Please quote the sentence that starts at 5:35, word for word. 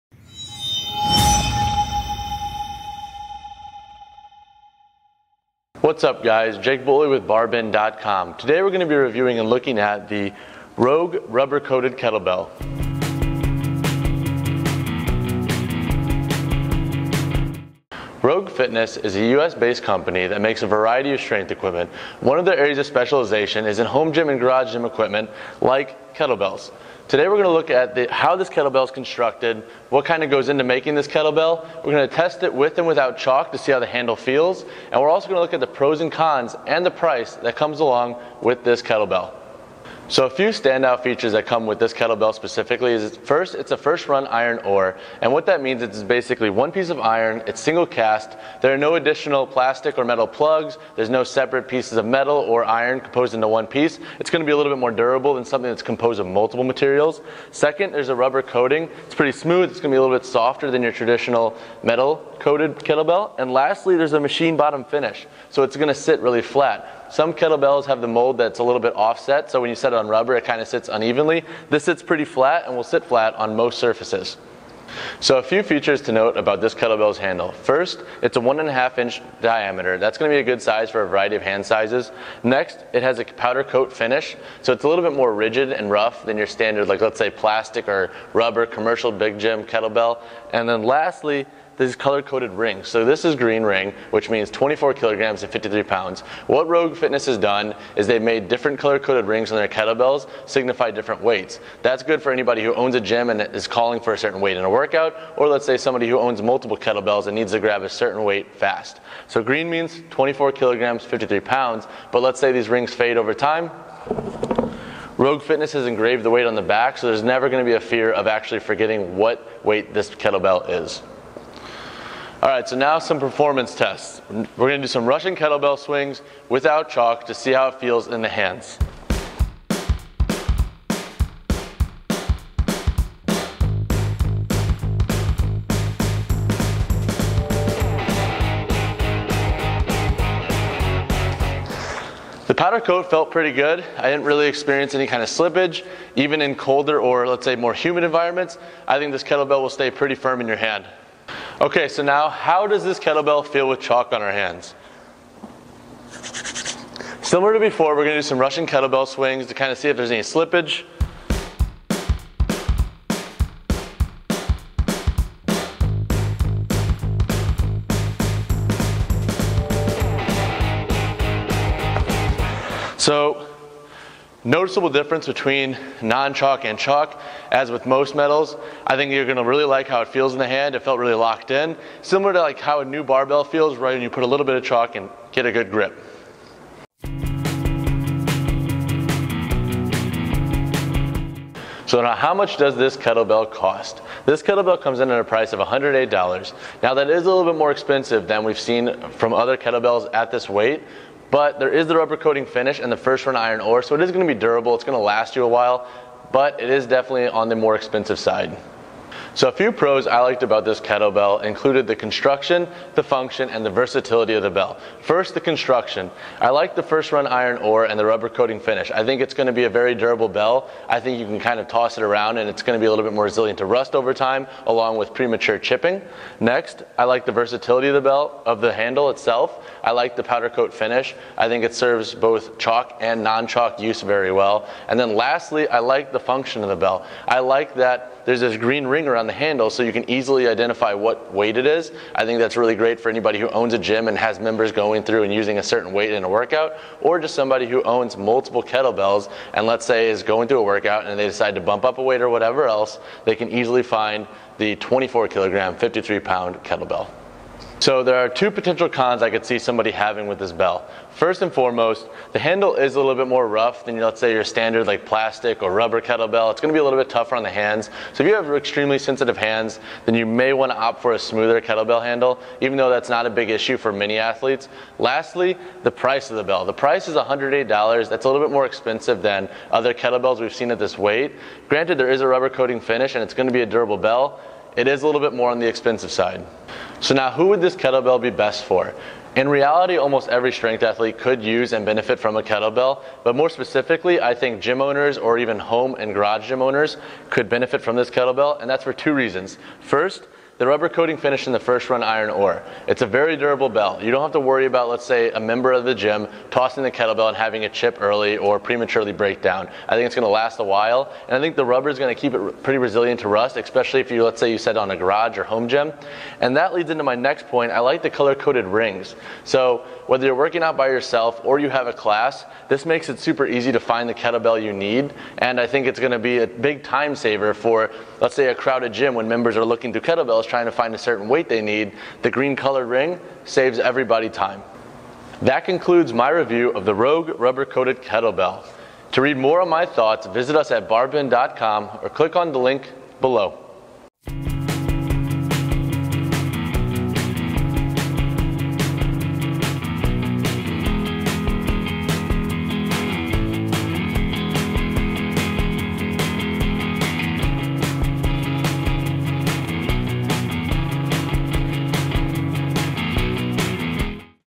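That concludes my review of the Rogue Rubber Coated Kettlebell.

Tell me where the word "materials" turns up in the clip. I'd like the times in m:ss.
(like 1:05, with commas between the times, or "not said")
0:56.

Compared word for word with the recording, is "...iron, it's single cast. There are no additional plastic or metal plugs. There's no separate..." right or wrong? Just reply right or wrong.
right.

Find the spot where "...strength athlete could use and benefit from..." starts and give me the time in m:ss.
4:50.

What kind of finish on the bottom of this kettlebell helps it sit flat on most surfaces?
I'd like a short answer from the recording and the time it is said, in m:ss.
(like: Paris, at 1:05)
machine bottom finish, at 1:04.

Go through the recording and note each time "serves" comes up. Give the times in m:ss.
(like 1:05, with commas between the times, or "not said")
3:51.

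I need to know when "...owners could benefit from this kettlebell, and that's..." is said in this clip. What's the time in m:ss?
4:56.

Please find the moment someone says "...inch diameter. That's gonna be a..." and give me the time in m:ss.
1:18.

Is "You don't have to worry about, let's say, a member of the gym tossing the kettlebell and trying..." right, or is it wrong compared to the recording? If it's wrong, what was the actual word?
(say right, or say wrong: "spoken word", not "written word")
wrong: "having", not "trying".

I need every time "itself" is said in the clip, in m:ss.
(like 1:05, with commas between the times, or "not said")
3:49.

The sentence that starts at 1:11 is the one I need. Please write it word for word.
This sits pretty flat and will sit flat on most surfaces.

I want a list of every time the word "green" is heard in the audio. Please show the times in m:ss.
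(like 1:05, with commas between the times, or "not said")
1:33, 1:49, 3:58, 5:32.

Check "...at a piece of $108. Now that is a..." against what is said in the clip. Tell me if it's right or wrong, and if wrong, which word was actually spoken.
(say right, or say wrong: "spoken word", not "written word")
wrong: "price", not "piece".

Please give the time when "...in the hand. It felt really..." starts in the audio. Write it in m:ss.
3:00.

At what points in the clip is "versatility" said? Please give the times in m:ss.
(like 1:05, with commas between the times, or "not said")
3:33, 3:47.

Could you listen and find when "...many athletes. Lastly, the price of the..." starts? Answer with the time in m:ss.
4:33.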